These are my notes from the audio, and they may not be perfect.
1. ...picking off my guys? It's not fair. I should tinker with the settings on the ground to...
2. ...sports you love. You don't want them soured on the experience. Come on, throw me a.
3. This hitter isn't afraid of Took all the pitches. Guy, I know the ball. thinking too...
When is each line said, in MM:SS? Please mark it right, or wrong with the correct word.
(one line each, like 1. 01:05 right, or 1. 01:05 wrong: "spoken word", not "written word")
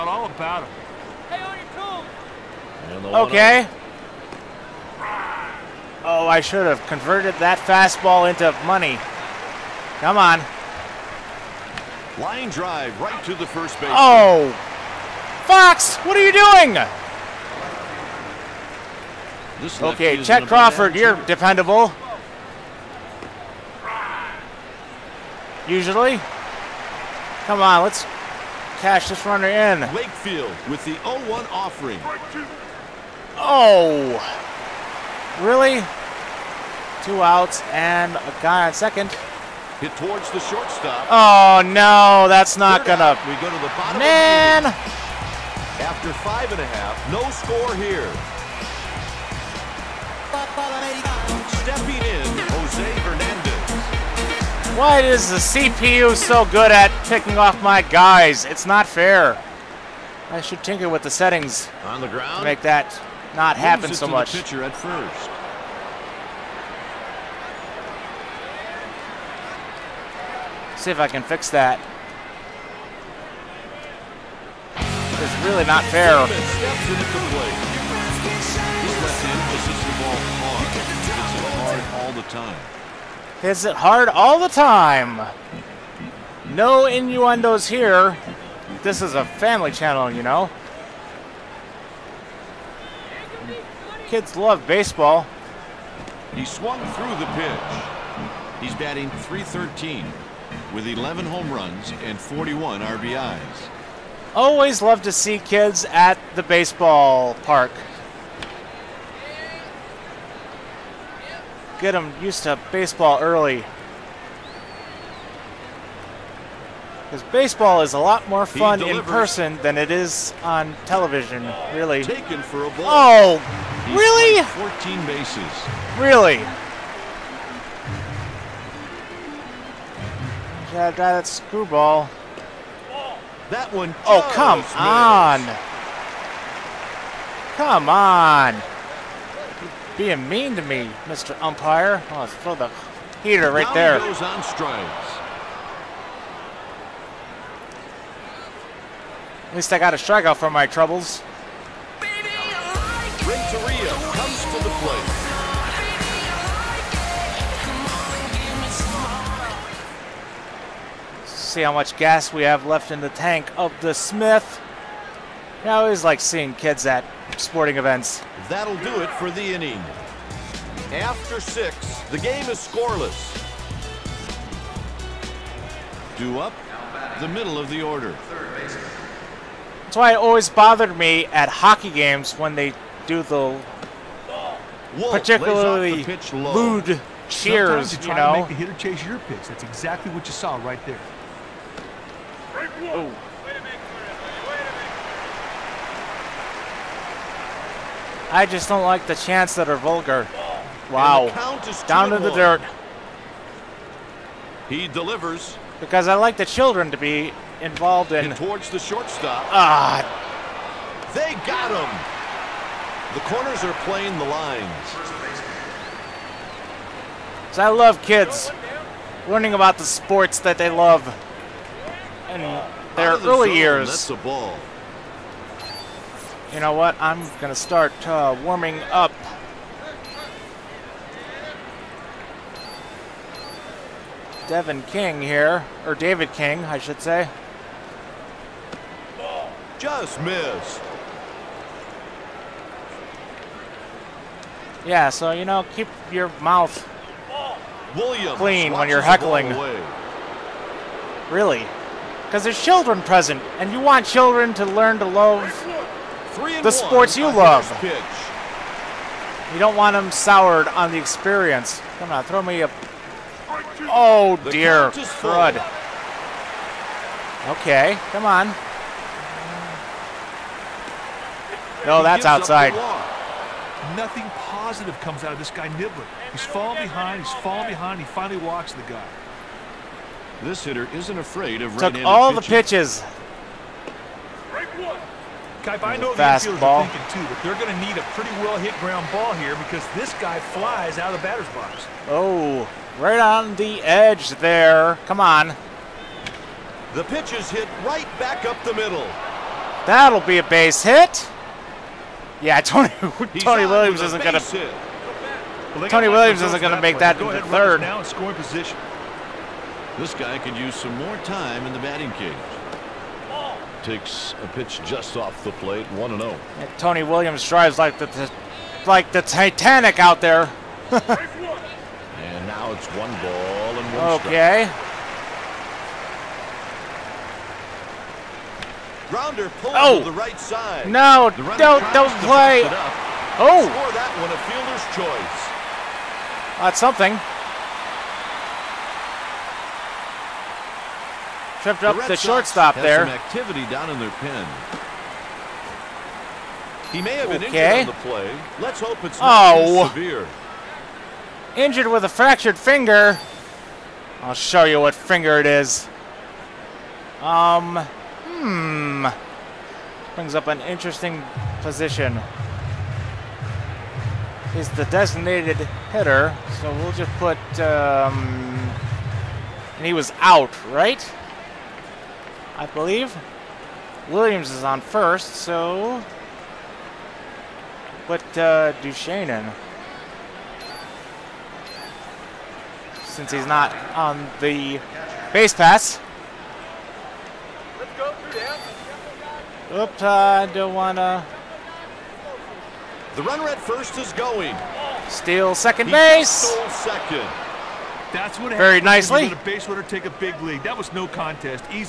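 1. 00:57 right
2. 04:16 right
3. 04:40 right.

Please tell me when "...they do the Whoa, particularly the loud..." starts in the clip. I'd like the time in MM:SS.
03:02.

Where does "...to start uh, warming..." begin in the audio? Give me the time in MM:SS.
03:47.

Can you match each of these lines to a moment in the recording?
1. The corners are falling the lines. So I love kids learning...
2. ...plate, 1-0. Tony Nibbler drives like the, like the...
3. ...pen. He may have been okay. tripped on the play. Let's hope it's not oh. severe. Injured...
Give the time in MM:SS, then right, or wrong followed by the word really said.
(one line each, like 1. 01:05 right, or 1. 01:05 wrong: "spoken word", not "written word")
1. 03:33 wrong: "playing", not "falling"
2. 05:15 wrong: "Williams", not "Nibbler"
3. 05:44 wrong: "injured", not "tripped".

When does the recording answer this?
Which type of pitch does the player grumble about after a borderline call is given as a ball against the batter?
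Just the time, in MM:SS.
02:11.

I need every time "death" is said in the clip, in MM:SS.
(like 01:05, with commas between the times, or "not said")
not said.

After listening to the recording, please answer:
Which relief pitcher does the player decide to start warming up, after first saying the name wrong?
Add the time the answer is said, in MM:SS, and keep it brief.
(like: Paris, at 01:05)
David King, at 03:55.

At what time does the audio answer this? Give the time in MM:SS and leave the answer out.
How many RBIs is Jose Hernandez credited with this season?
01:42.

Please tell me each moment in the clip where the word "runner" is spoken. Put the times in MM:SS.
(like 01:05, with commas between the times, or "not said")
00:29, 06:33, 06:39.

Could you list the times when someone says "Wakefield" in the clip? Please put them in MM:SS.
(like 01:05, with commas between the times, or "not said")
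00:29.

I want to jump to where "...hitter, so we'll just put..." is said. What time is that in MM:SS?
06:05.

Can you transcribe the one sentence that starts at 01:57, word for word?
Because baseball is a lot more fun in person than it is on television, really.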